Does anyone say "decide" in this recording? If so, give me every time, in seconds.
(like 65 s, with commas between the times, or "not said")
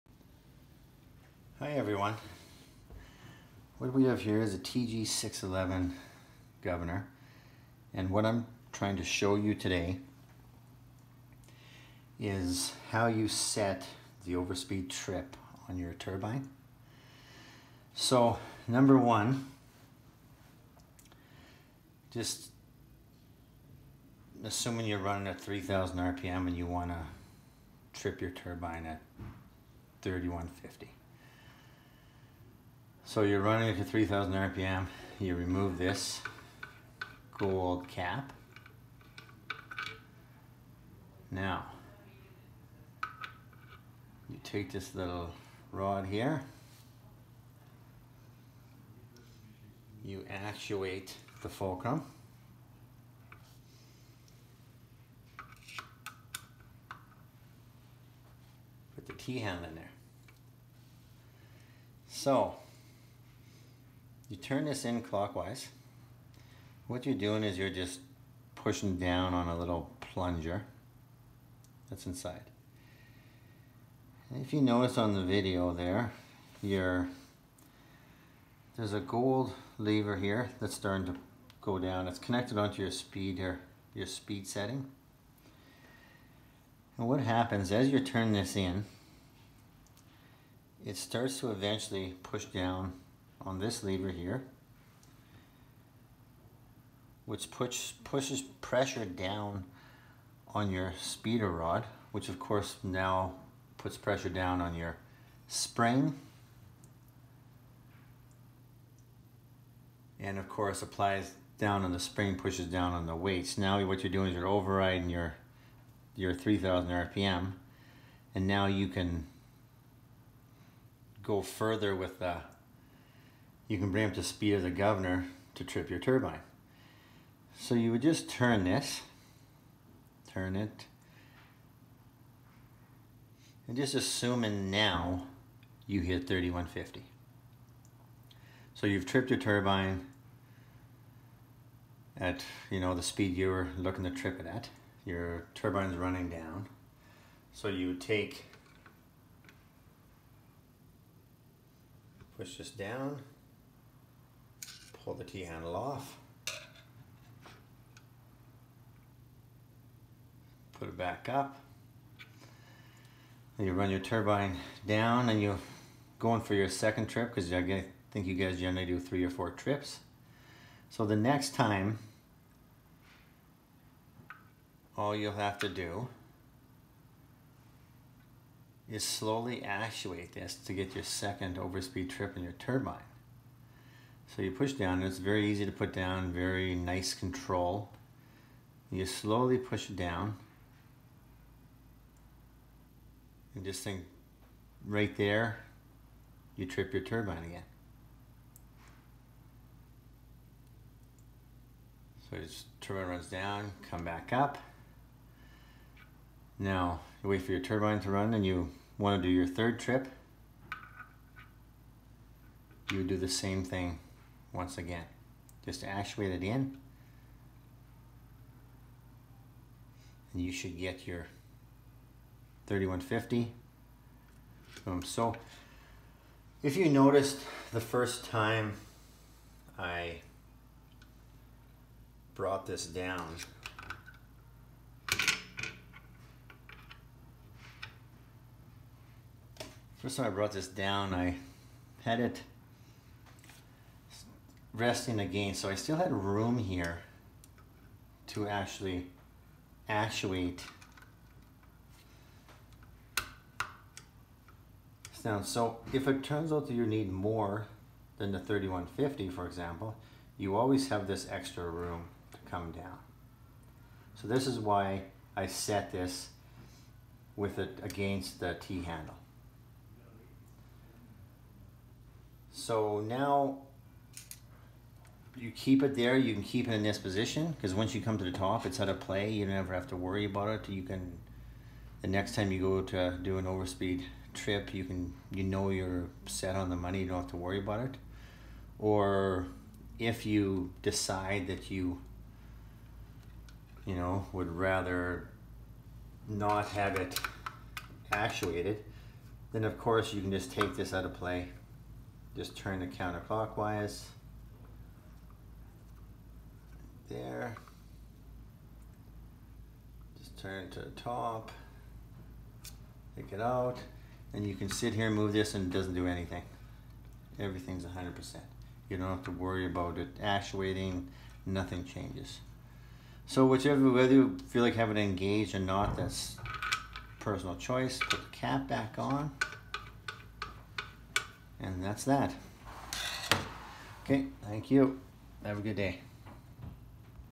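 290 s.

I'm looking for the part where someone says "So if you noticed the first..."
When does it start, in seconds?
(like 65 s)
225 s.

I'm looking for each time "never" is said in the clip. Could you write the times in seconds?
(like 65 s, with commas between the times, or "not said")
279 s.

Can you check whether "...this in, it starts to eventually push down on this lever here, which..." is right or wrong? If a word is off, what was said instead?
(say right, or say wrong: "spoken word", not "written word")
right.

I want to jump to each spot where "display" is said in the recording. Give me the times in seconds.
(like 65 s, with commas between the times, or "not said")
not said.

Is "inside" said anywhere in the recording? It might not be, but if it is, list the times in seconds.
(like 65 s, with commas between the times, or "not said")
72 s.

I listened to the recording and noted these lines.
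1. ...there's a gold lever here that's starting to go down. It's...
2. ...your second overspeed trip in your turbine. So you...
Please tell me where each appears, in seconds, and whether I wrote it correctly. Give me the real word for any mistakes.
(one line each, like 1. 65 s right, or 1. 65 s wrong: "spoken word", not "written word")
1. 78 s right
2. 180 s right.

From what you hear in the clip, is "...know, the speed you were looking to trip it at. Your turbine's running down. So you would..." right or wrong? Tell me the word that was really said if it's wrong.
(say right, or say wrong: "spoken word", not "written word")
right.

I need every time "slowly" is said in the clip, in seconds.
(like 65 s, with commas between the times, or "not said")
179 s, 189 s.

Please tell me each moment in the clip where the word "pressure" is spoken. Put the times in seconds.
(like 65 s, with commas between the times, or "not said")
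98 s, 103 s.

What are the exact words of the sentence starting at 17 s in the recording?
So number one, just assuming you're running at 3000 RPM and you want to trip your turbine at 3150.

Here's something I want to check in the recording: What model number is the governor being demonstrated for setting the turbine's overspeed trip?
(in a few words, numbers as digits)
TG611.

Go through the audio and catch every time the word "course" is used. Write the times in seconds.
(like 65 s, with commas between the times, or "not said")
102 s, 110 s, 299 s.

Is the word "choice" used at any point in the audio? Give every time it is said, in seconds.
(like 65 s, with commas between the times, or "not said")
327 s.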